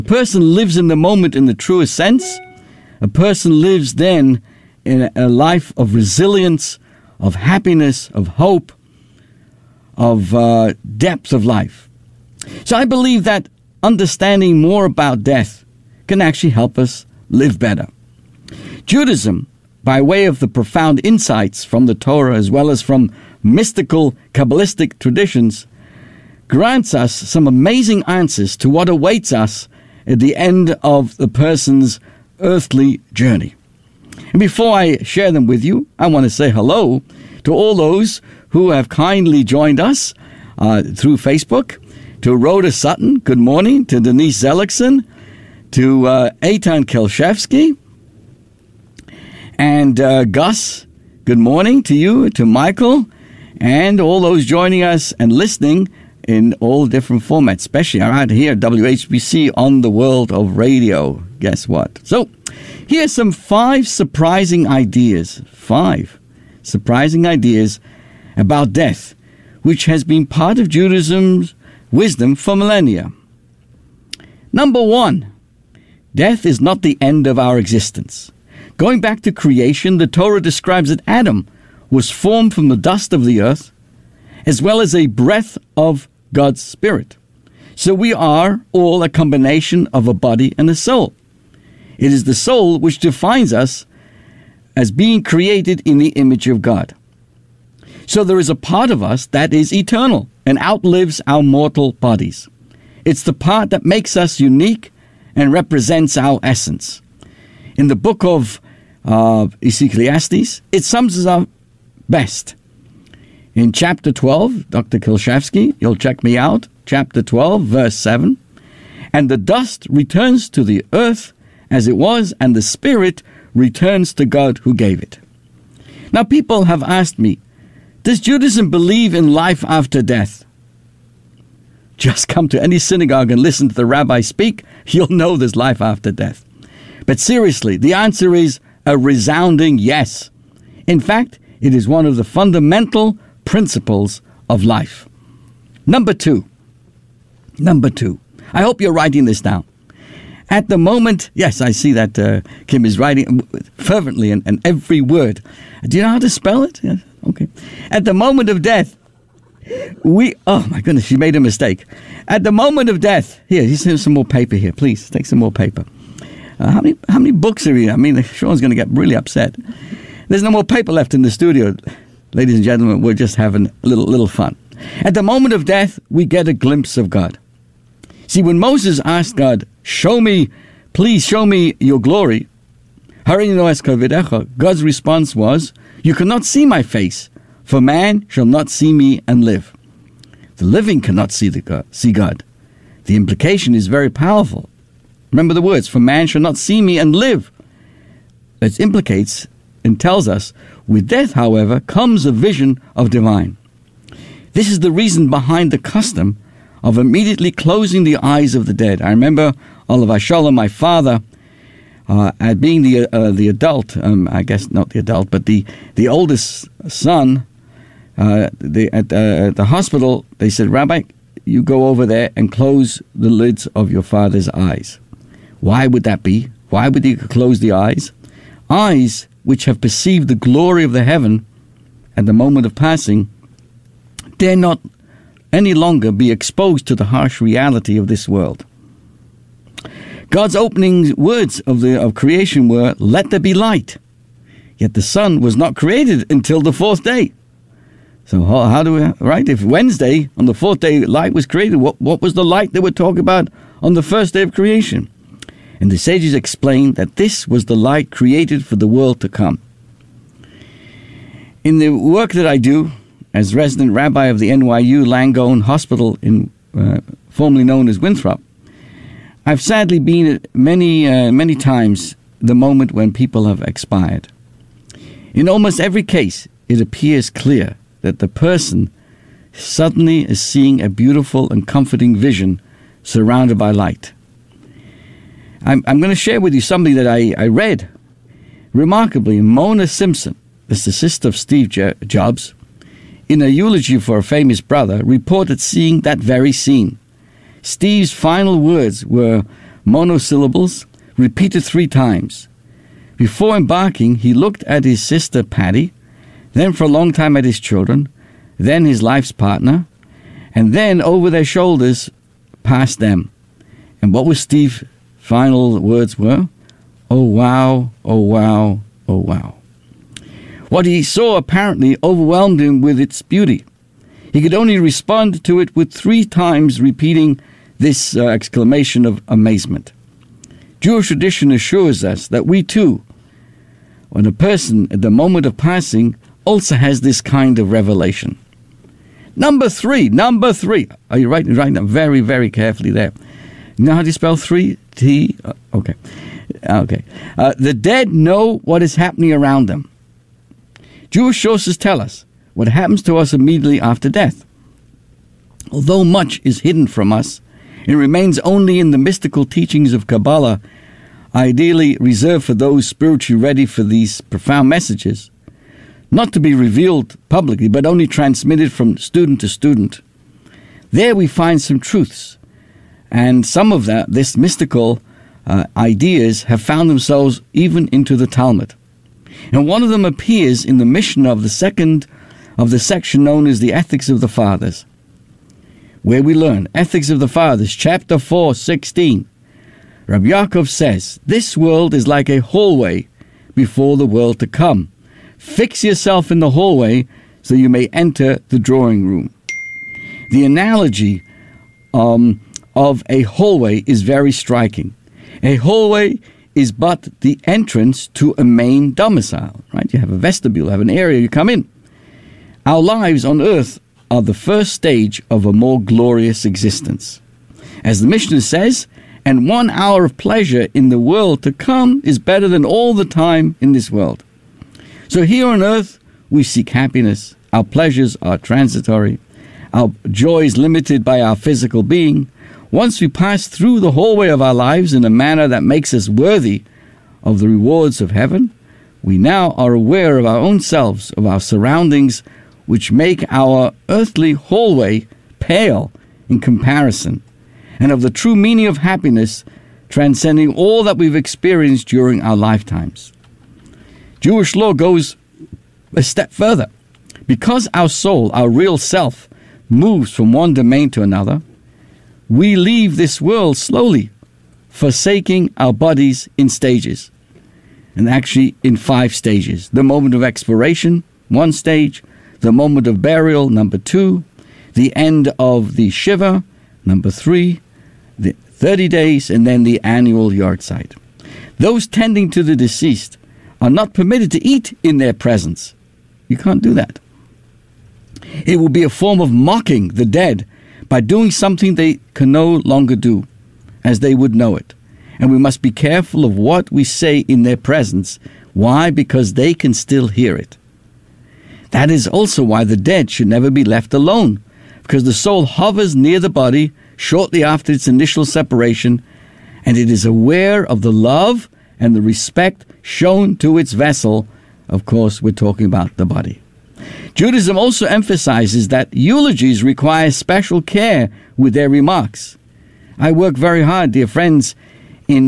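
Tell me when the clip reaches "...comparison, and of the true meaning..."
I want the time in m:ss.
7:26.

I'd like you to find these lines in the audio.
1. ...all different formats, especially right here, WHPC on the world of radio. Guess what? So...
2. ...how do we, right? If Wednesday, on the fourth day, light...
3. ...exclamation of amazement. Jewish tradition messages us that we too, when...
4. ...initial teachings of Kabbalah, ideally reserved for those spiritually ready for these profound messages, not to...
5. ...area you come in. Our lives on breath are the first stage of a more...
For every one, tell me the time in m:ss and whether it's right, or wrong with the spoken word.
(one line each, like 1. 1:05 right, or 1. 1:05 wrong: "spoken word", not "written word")
1. 0:56 right
2. 4:08 right
3. 5:28 wrong: "assures", not "messages"
4. 5:58 wrong: "mystical", not "initial"
5. 6:50 wrong: "earth", not "breath".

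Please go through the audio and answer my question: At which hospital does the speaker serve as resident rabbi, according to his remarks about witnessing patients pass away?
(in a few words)
NYU Langone Hospital.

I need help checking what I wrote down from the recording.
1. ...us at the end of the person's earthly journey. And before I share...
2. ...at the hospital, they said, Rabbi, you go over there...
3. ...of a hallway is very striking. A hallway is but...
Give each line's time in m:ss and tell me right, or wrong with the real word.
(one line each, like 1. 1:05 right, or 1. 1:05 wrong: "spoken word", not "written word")
1. 0:29 right
2. 3:39 right
3. 6:42 right.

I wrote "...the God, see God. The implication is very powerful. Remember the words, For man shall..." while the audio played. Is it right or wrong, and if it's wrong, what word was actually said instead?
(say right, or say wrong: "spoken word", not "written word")
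right.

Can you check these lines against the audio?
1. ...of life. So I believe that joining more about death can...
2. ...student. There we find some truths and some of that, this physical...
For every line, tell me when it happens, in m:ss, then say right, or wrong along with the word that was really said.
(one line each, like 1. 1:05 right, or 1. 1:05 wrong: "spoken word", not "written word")
1. 0:11 wrong: "understanding", not "joining"
2. 6:09 wrong: "mystical", not "physical".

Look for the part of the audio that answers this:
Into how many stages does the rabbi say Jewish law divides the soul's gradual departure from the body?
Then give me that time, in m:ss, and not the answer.
7:48.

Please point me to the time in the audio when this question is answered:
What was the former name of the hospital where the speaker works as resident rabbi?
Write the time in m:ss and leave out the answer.
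4:27.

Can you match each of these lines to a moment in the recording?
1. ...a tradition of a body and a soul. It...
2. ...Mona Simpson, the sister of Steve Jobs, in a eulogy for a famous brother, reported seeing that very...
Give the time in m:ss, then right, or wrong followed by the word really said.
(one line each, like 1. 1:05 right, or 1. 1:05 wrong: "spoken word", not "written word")
1. 1:29 wrong: "combination", not "tradition"
2. 4:49 right.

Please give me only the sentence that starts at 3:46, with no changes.
Why would he close the eyes?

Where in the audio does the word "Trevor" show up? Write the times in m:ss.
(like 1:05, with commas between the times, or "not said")
not said.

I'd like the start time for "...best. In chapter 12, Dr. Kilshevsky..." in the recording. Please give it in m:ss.
1:52.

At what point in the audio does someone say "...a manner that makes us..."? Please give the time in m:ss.
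7:15.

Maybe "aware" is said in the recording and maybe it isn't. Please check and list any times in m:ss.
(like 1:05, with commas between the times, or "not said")
7:19, 8:30.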